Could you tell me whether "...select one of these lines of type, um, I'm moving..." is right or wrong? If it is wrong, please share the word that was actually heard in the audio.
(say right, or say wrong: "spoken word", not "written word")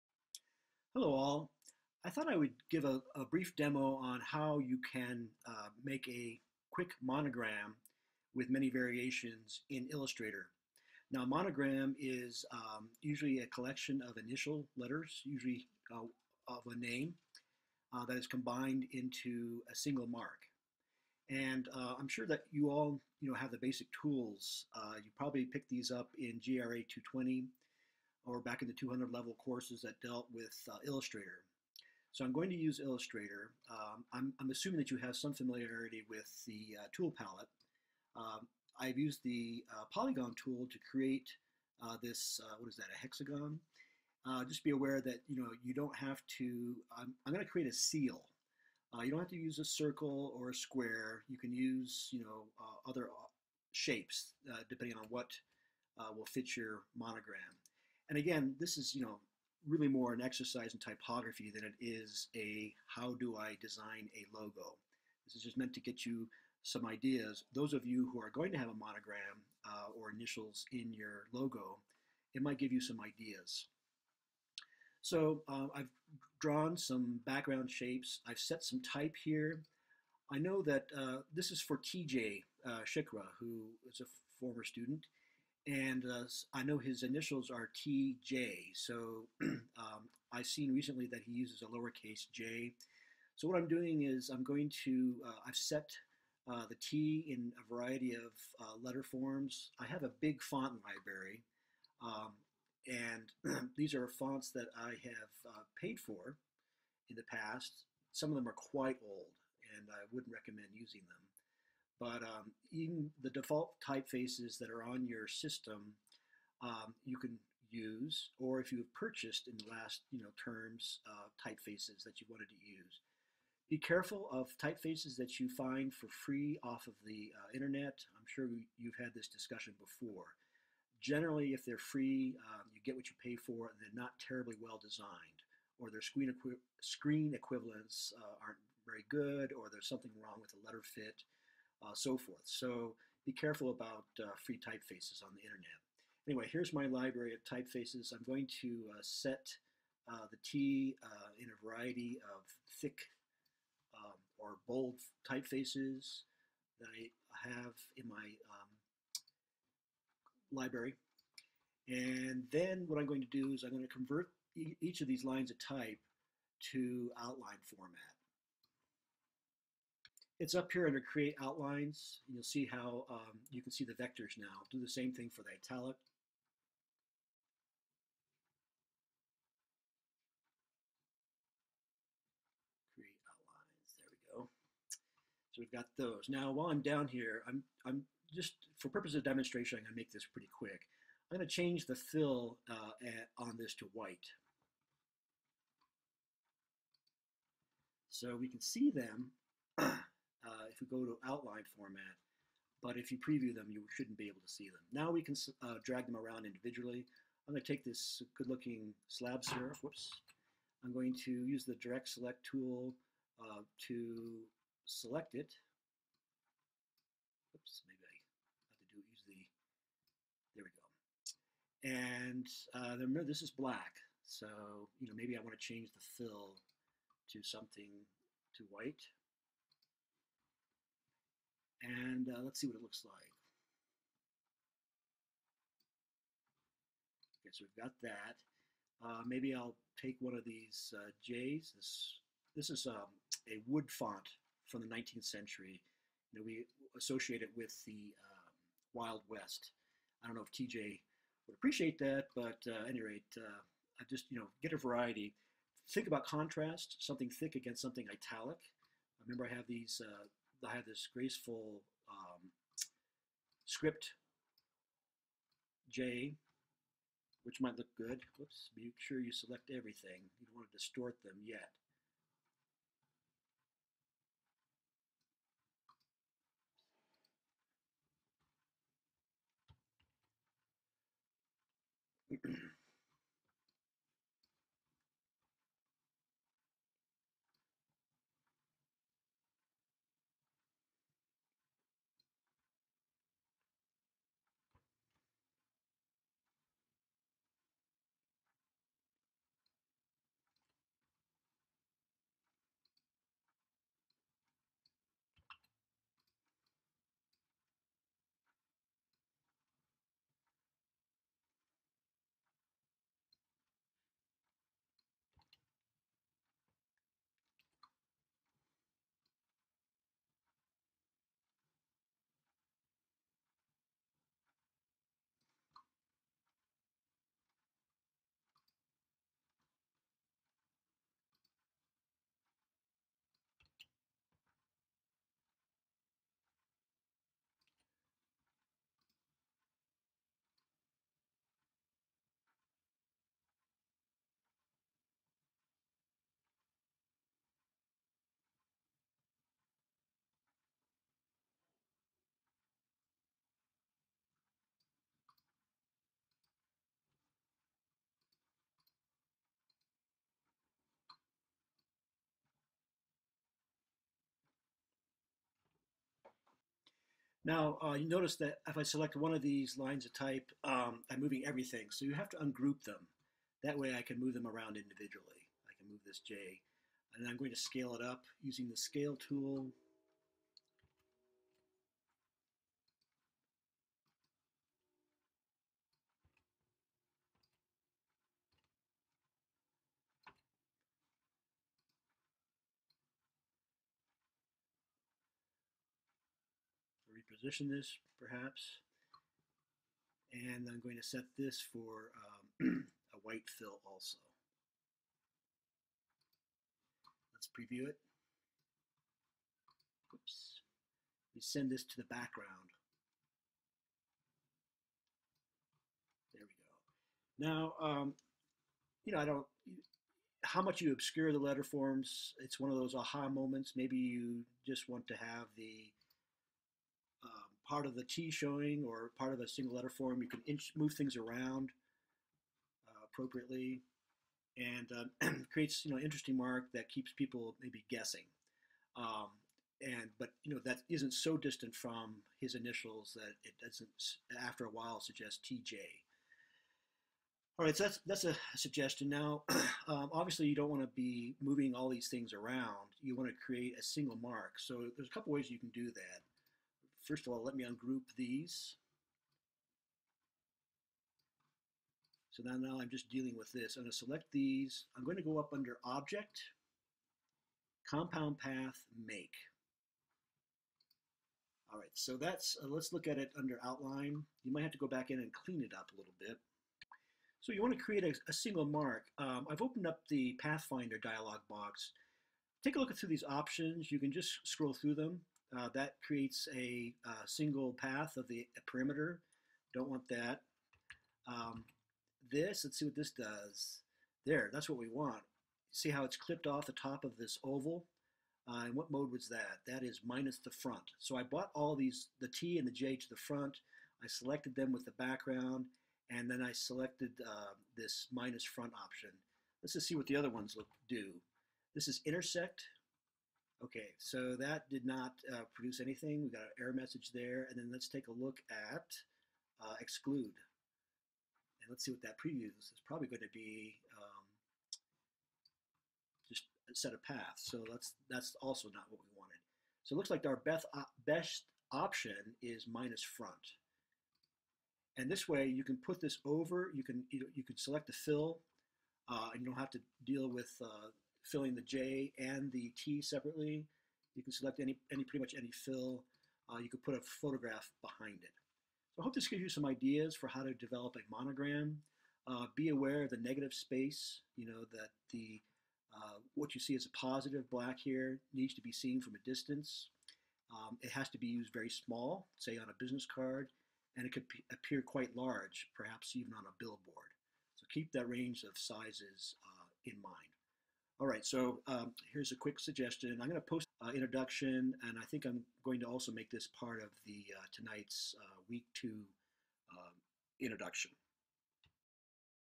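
right.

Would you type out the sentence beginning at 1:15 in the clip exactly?
So uh, I've drawn some background shapes.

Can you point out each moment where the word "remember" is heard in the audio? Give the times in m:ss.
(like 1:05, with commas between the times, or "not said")
3:42, 4:19.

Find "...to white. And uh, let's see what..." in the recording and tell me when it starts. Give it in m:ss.
3:48.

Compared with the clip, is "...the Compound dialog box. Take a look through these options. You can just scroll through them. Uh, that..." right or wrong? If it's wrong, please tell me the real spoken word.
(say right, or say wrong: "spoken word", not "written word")
wrong: "Pathfinder", not "Compound".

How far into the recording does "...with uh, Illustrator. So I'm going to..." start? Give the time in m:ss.
0:30.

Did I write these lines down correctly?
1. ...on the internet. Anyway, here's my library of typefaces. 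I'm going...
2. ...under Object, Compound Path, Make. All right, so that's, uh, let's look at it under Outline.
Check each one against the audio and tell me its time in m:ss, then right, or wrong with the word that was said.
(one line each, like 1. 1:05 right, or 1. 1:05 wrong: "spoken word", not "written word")
1. 2:25 right
2. 7:45 right.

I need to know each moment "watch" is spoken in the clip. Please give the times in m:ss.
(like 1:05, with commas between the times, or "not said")
not said.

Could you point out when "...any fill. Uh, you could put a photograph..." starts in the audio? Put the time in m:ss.
9:05.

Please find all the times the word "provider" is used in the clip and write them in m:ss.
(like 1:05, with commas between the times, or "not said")
not said.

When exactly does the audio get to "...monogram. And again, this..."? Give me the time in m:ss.
0:56.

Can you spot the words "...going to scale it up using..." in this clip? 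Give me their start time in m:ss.
6:17.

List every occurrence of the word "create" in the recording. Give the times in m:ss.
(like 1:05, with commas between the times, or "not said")
0:40, 0:47, 2:50, 3:02, 7:15, 7:33, 7:57, 8:06.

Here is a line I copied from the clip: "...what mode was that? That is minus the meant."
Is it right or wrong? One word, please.
wrong.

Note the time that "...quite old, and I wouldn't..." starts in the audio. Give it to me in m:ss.
1:48.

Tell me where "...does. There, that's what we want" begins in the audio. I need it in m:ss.
8:13.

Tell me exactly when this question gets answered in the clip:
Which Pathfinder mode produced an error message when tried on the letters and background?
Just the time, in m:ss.
8:32.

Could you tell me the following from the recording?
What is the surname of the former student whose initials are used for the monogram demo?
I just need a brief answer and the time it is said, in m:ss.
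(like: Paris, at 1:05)
Shikra, at 1:22.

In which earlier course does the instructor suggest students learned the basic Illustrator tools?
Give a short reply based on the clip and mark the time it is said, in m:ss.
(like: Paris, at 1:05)
GRA 220, at 0:26.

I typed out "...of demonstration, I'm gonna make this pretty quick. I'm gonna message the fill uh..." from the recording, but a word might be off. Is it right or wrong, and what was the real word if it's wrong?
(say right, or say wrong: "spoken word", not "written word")
wrong: "change", not "message".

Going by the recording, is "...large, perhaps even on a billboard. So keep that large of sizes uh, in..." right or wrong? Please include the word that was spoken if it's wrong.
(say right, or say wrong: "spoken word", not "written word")
wrong: "range", not "large".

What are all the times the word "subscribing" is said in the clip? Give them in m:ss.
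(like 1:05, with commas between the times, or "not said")
not said.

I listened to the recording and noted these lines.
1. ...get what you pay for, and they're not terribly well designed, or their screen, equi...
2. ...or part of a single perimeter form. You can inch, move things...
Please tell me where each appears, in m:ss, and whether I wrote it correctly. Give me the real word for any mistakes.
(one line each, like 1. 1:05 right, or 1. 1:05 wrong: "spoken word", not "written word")
1. 2:12 right
2. 7:08 wrong: "letter", not "perimeter".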